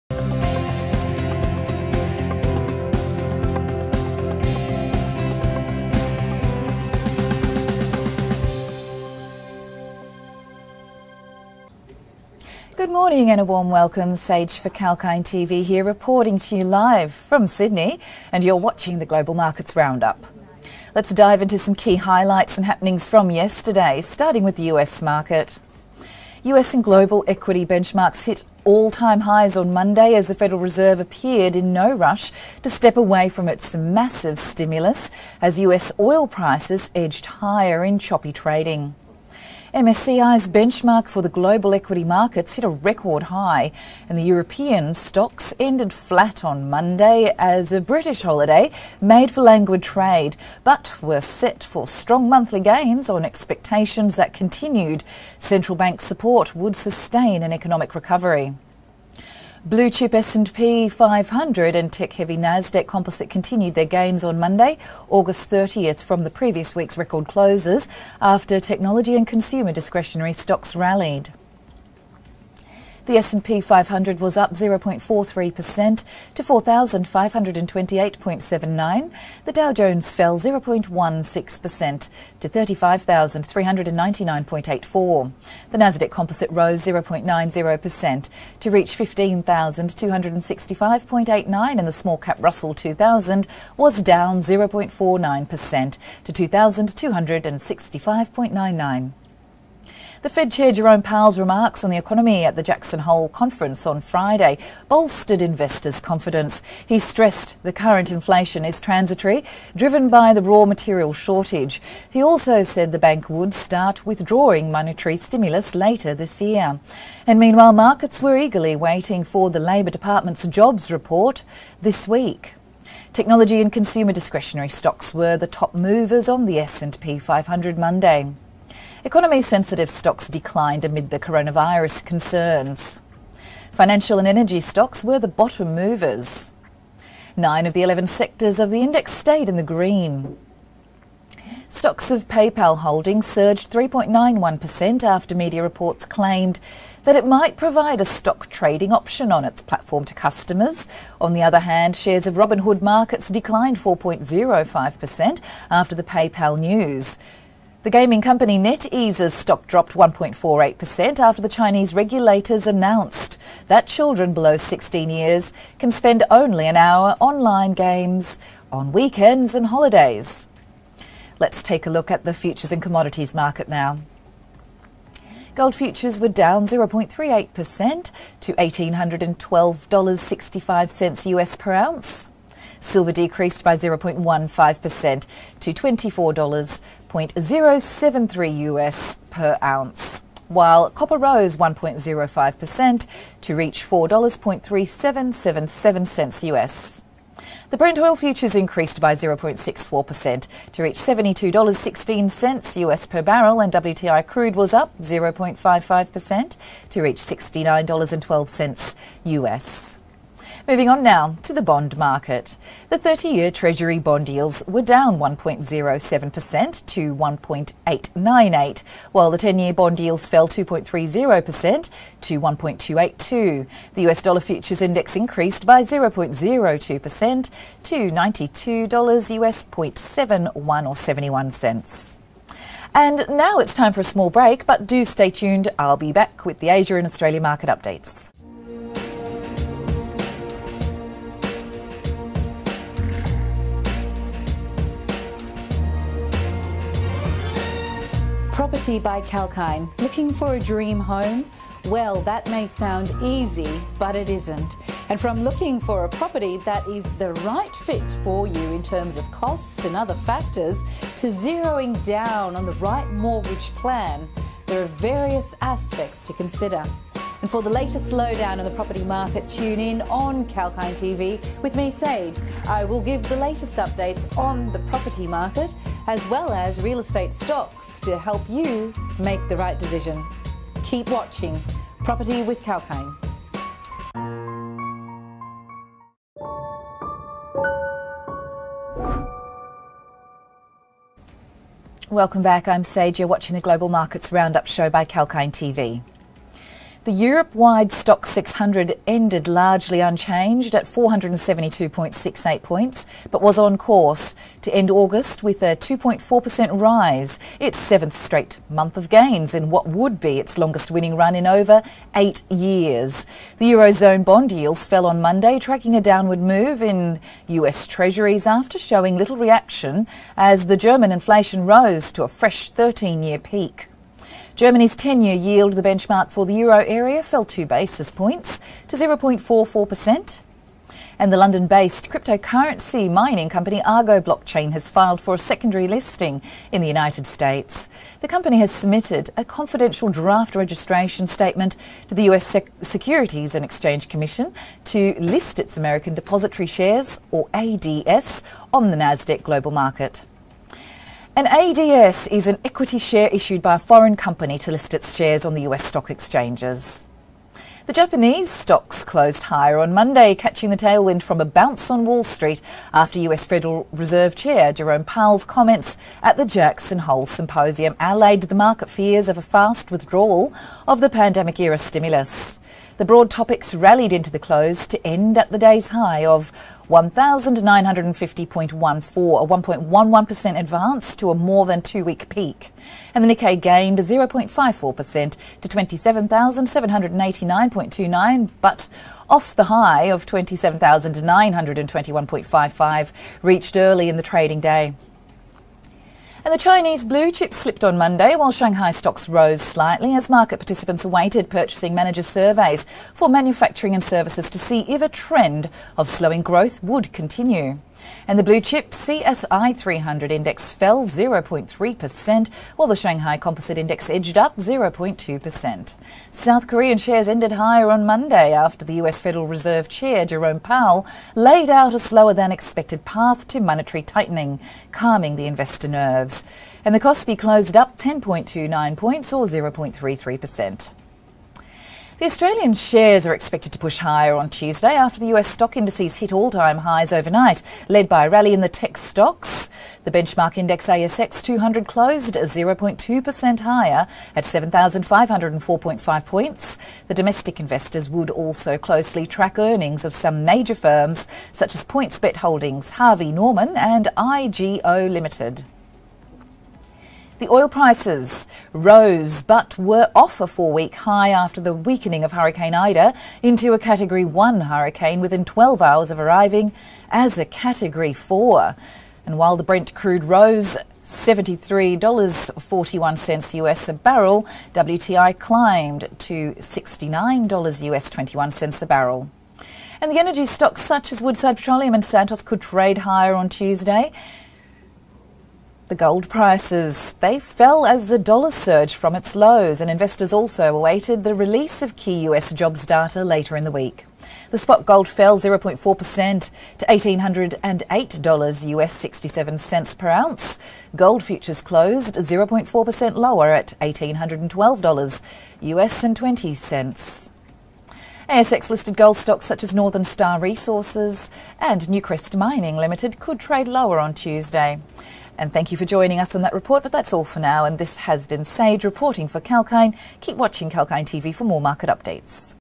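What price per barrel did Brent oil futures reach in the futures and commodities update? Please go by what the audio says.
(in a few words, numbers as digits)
$72.16.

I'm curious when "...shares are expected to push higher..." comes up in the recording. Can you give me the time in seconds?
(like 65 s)
432 s.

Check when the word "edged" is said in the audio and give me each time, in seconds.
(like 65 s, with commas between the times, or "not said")
36 s, 414 s.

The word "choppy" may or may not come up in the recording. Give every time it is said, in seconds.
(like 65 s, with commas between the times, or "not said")
37 s.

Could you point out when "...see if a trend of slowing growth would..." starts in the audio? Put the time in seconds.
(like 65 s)
404 s.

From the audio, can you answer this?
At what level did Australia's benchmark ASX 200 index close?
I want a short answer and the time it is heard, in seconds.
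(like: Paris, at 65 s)
7,504.5 points, at 444 s.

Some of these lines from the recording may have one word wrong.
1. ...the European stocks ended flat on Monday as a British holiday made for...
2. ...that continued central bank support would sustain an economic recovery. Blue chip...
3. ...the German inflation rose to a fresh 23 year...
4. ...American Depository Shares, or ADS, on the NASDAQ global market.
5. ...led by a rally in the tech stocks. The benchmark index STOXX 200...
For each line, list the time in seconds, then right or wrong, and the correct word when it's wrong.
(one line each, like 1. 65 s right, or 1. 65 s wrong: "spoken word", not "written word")
1. 44 s right
2. 54 s right
3. 320 s wrong: "13", not "23"
4. 345 s right
5. 437 s wrong: "ASX", not "STOXX".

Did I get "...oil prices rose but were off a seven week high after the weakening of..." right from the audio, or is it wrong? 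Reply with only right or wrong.
wrong.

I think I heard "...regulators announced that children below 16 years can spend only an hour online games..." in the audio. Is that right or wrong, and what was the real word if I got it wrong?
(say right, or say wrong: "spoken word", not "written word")
right.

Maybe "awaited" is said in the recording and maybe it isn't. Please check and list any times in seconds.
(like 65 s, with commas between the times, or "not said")
401 s, 490 s.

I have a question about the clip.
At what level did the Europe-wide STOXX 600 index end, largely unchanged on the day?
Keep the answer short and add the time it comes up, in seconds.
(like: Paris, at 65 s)
472.68 points, at 300 s.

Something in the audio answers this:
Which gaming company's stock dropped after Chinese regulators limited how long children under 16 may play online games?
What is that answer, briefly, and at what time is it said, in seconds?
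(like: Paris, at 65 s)
NetEase, at 158 s.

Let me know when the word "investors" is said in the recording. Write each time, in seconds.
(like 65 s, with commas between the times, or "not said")
105 s, 425 s, 447 s, 489 s.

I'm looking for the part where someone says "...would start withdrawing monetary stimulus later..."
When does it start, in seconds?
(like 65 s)
113 s.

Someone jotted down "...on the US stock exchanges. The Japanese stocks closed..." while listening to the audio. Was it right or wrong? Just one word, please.
right.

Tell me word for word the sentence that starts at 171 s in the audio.
Let's take a look at the futures and commodities market now.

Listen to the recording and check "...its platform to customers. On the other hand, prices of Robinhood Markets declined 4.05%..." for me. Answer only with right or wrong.
wrong.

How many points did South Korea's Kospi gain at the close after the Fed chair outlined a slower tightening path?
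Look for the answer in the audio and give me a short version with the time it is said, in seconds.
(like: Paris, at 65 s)
10.29, at 427 s.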